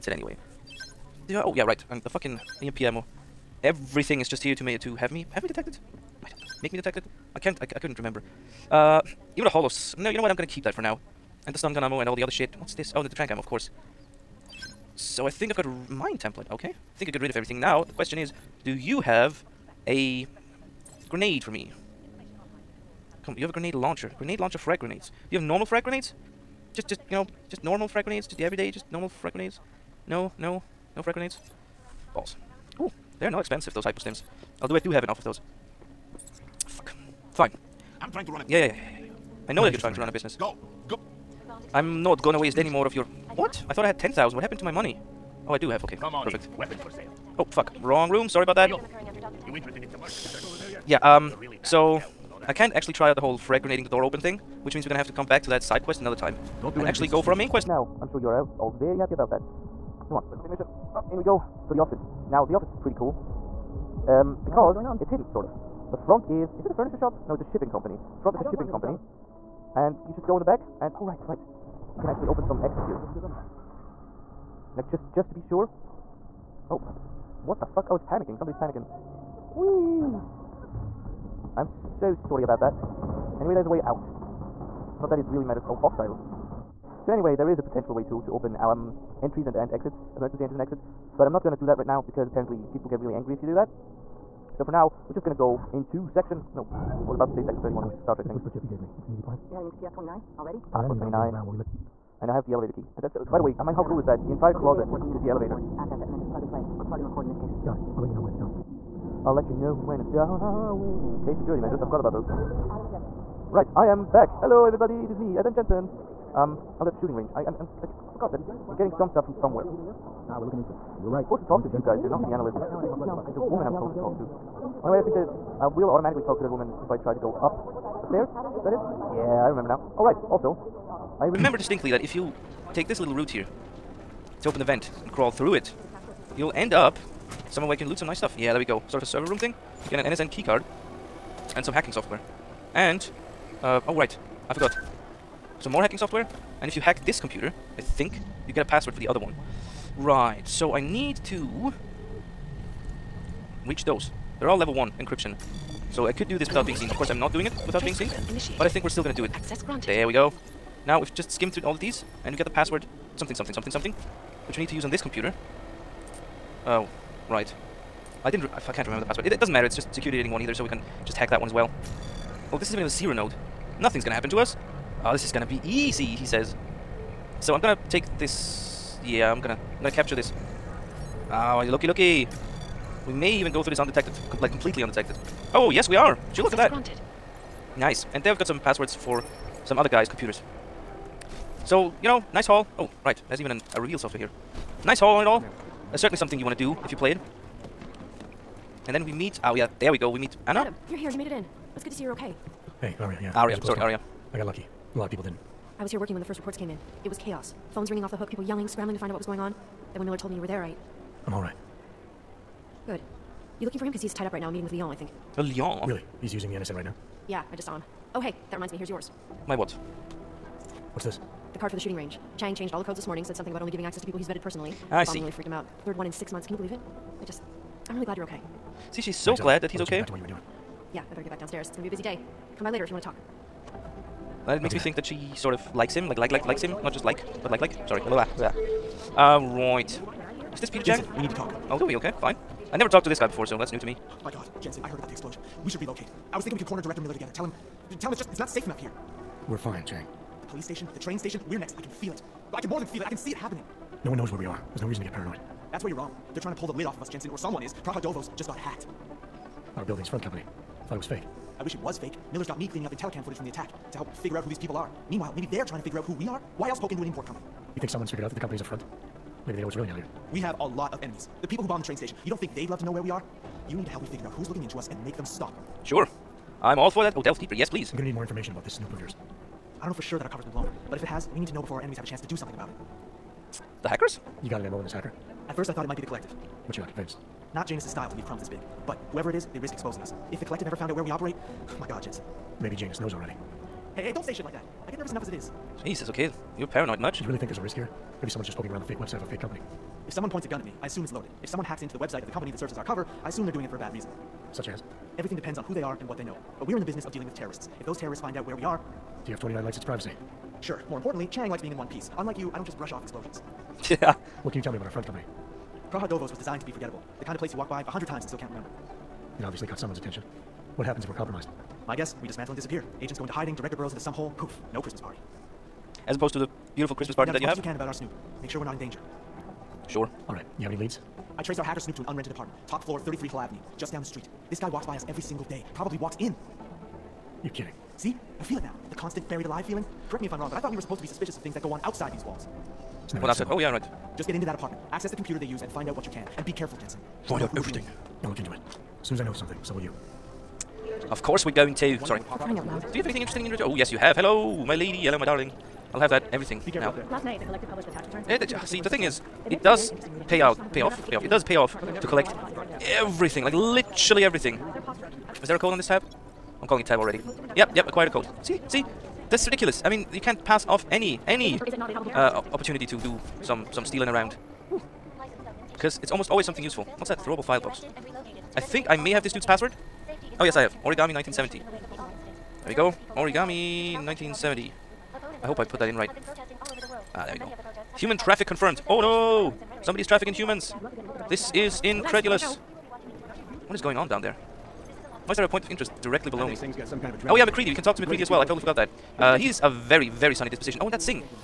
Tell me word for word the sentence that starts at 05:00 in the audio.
If someone points a gun at me, I assume it's loaded.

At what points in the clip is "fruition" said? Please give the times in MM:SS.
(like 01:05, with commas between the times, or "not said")
not said.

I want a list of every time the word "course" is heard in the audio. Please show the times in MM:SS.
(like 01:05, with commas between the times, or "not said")
00:13, 02:36, 05:51.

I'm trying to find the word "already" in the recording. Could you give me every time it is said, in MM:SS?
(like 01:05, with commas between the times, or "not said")
01:40, 04:53, 06:06.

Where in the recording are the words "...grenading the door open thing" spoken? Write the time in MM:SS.
00:53.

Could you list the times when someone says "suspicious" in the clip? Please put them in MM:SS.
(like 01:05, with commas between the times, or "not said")
05:41.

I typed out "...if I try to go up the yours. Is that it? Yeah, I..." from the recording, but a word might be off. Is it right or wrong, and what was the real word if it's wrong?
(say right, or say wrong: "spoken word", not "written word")
wrong: "stairs", not "yours".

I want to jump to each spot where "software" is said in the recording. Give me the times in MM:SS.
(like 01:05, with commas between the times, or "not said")
02:21, 02:25, 03:13.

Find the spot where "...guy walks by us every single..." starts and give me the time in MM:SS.
05:34.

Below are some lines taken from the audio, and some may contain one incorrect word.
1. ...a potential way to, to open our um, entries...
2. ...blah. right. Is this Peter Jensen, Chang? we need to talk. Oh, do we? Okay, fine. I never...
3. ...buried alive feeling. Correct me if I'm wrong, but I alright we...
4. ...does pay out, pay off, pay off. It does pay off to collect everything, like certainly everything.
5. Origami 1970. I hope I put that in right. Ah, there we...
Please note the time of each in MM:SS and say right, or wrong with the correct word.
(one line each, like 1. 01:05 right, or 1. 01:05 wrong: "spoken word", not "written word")
1. 01:27 right
2. 03:58 right
3. 05:39 wrong: "thought", not "alright"
4. 05:59 wrong: "literally", not "certainly"
5. 06:23 right.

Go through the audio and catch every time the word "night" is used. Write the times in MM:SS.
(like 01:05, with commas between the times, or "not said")
05:57.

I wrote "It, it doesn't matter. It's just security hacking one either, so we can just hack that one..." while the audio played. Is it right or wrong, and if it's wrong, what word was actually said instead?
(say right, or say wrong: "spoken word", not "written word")
wrong: "rating", not "hacking".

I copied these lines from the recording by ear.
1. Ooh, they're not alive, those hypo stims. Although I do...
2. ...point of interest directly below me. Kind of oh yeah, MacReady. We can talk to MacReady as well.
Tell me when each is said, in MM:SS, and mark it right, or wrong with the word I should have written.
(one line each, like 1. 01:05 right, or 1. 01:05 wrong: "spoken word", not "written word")
1. 00:32 wrong: "expensive", not "alive"
2. 06:35 right.